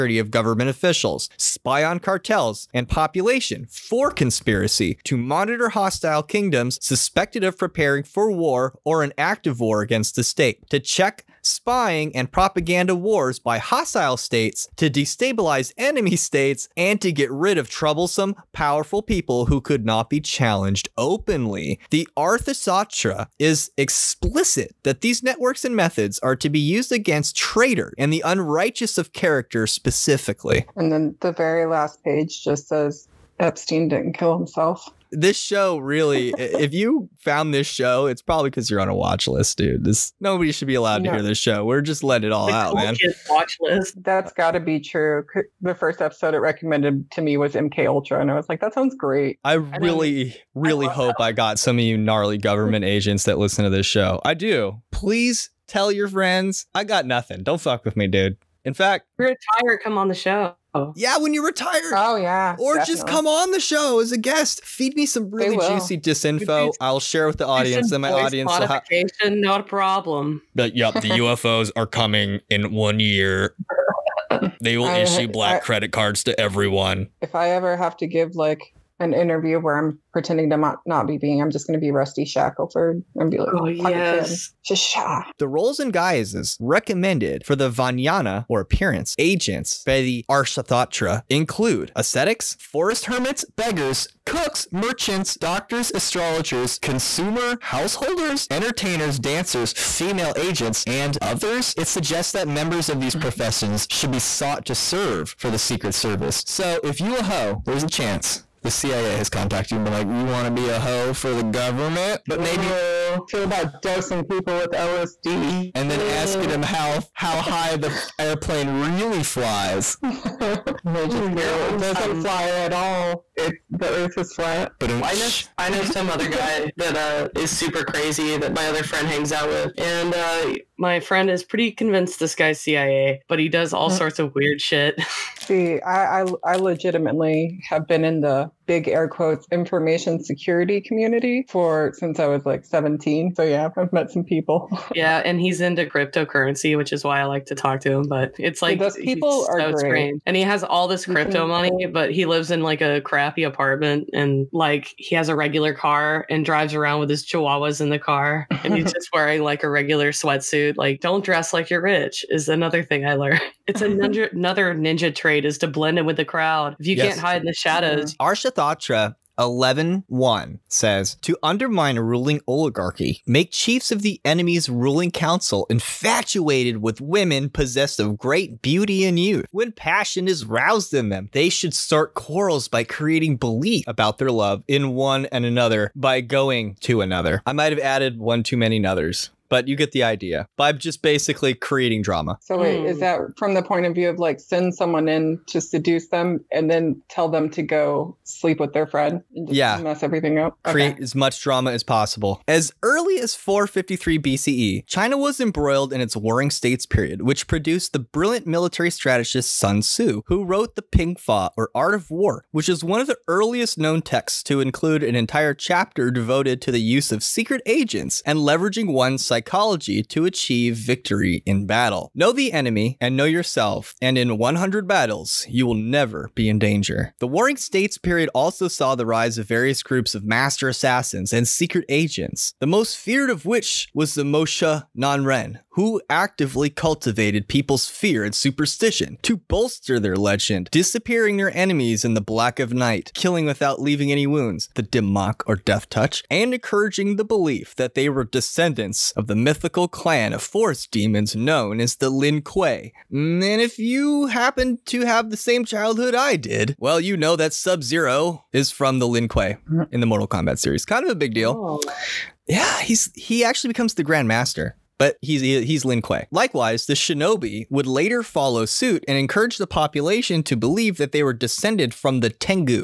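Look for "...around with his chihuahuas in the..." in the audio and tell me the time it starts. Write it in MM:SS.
02:36.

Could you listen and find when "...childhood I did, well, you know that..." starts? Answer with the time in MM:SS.
04:15.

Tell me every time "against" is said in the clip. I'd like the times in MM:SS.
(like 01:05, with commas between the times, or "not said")
00:09, 00:26.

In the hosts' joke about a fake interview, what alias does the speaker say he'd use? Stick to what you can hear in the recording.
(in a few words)
Rusty Shackelford.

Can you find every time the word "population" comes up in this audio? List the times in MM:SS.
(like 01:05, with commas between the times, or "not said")
00:02, 04:29.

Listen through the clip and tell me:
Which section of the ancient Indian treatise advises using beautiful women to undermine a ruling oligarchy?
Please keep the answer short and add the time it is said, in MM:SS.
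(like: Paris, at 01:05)
11.1, at 02:49.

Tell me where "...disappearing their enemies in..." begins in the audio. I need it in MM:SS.
04:00.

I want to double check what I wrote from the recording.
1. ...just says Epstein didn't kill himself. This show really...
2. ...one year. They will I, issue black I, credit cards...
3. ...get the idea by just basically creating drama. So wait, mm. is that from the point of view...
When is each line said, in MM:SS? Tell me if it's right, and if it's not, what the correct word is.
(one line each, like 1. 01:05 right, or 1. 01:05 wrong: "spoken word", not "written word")
1. 00:32 right
2. 01:12 right
3. 03:09 right.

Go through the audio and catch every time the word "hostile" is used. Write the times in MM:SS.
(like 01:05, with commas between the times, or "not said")
00:05, 00:13.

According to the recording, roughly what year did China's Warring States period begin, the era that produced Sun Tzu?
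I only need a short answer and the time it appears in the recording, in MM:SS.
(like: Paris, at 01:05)
453 BCE, at 03:23.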